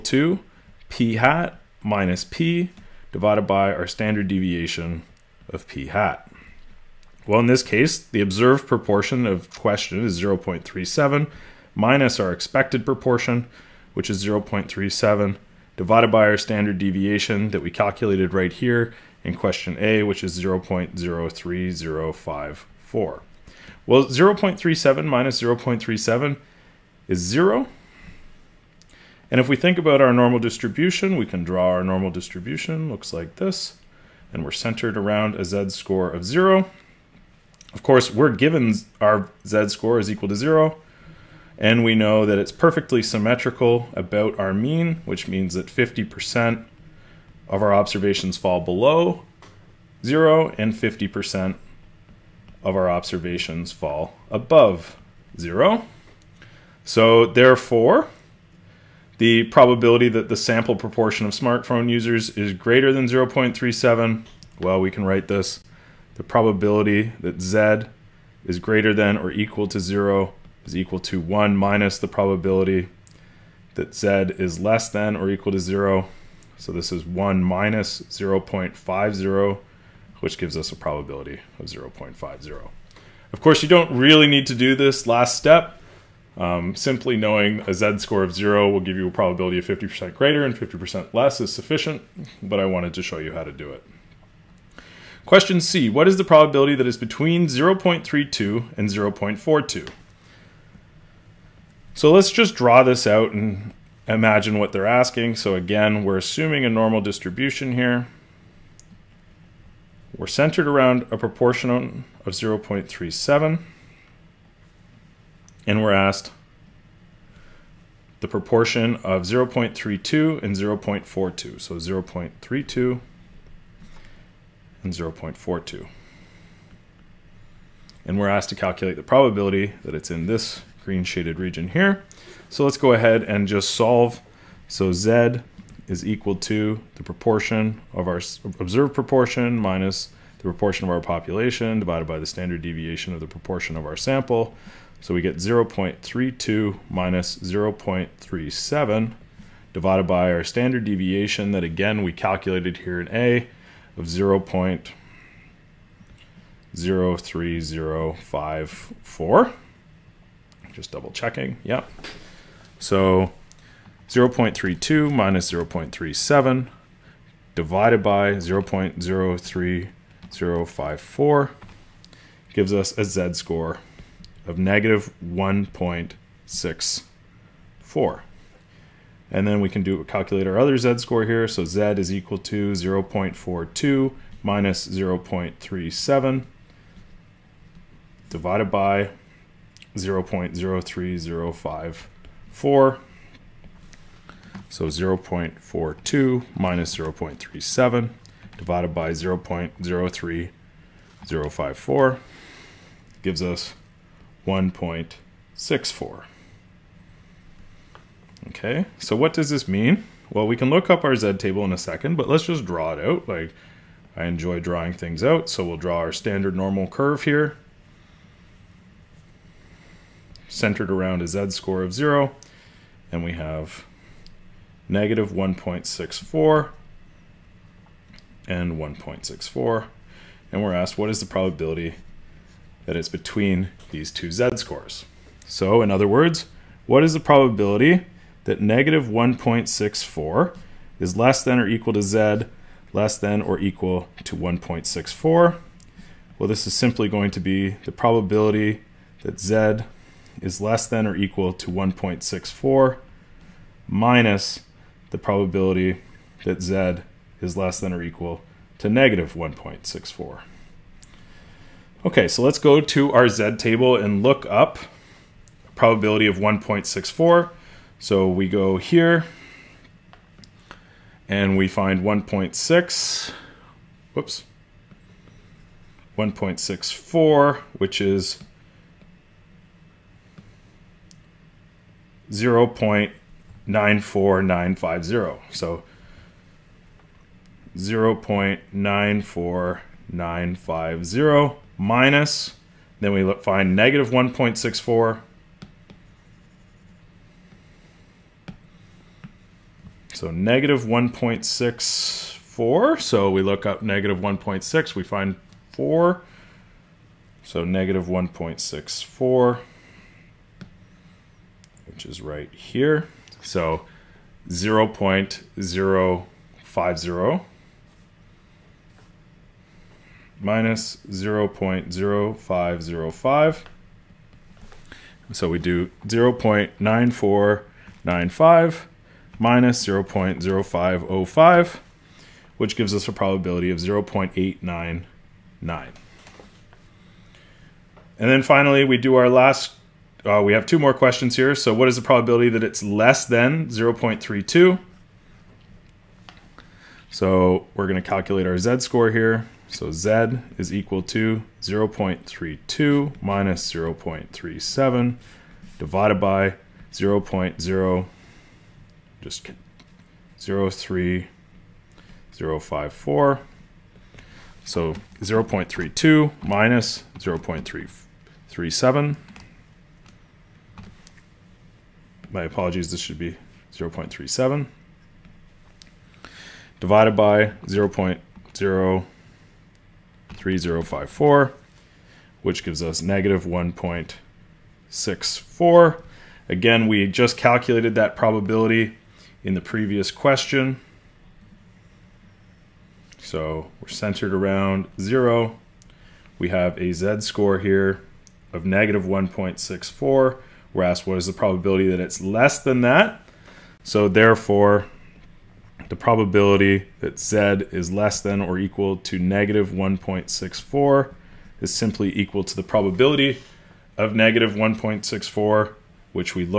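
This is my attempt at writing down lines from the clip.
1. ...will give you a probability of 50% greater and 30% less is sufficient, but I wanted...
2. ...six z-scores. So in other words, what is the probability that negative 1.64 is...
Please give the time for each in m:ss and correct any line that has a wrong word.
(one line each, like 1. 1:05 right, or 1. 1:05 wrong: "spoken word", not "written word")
1. 1:28 wrong: "50", not "30"
2. 3:54 wrong: "two", not "six".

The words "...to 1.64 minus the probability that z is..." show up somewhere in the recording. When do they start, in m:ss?
4:11.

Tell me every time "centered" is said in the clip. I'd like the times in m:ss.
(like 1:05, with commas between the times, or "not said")
0:34, 1:50, 3:40, 6:33.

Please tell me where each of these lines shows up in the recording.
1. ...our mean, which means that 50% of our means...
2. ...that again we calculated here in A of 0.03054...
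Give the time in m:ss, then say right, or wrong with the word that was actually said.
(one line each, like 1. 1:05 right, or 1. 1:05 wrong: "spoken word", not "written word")
1. 0:44 wrong: "observations", not "means"
2. 2:31 right.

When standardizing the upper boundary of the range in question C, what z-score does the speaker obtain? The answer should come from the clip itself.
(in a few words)
1.64.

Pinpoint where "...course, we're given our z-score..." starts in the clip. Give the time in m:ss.
0:37.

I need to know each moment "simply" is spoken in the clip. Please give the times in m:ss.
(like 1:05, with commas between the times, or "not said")
1:26, 4:06, 6:51.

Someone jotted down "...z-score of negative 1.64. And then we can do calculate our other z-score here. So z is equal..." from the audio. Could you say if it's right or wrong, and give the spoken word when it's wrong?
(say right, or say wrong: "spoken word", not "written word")
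right.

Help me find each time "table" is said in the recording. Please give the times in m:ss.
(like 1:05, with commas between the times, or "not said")
3:31, 4:23.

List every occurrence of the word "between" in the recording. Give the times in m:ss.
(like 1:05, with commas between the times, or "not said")
1:36, 3:53.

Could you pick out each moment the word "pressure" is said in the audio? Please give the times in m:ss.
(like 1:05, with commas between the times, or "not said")
not said.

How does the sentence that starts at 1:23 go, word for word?
Of course, you don't really need to do this last step.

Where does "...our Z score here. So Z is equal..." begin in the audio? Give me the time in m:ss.
5:48.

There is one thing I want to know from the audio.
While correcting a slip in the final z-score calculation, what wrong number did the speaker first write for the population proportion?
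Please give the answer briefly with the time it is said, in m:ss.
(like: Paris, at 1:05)
0.337, at 6:07.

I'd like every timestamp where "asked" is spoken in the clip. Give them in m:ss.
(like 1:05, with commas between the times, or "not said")
1:55, 2:08, 3:50, 6:40.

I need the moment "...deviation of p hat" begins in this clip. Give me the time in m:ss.
0:04.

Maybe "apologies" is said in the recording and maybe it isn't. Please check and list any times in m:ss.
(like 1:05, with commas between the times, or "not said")
6:12.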